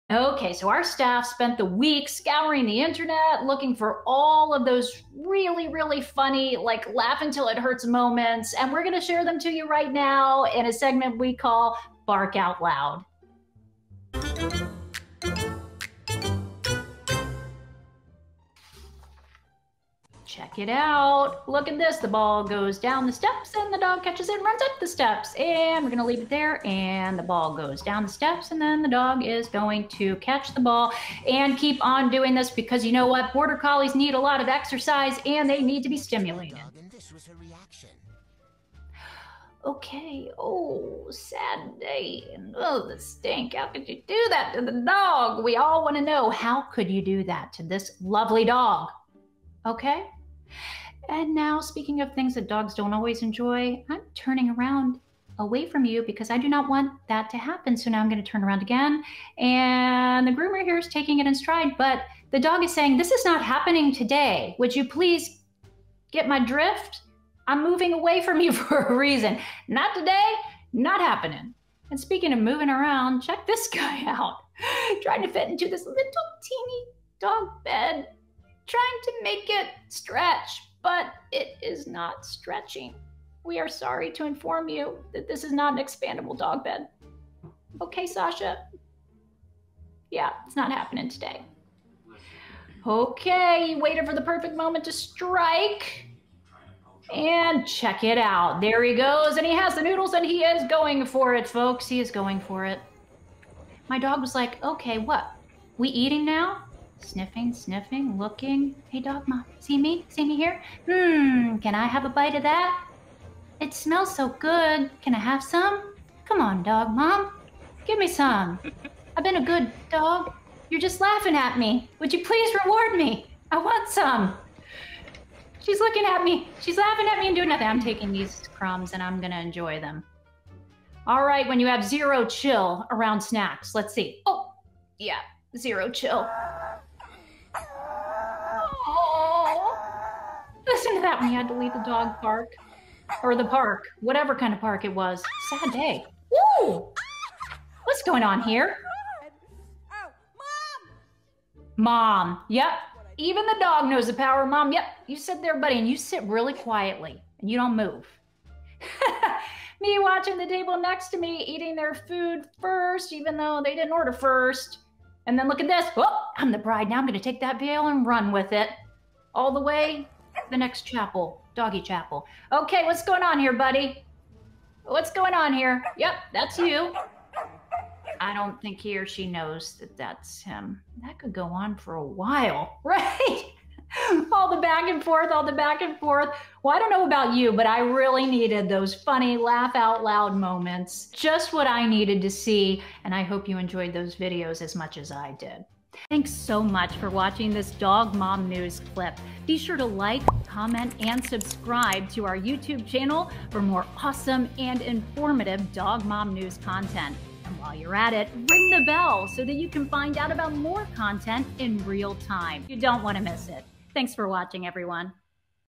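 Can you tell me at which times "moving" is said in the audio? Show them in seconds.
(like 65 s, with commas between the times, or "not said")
67 s, 72 s.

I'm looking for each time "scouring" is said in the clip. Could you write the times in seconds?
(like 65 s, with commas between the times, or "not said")
2 s.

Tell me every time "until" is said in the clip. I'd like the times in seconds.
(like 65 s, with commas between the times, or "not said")
7 s.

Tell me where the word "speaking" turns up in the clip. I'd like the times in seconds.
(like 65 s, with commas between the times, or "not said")
51 s, 71 s.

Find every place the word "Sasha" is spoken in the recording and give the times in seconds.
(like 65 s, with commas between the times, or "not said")
88 s.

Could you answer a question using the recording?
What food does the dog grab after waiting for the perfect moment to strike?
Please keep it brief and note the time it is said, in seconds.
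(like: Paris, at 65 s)
Noodles, at 99 s.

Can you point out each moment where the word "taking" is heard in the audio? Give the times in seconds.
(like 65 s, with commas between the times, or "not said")
60 s, 127 s.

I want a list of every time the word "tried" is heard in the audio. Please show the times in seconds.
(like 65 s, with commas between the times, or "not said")
not said.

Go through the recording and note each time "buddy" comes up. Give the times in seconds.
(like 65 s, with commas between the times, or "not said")
155 s, 173 s.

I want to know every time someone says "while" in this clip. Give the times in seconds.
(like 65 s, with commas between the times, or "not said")
182 s, 207 s.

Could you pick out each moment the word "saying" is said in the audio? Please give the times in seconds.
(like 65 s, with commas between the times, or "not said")
62 s.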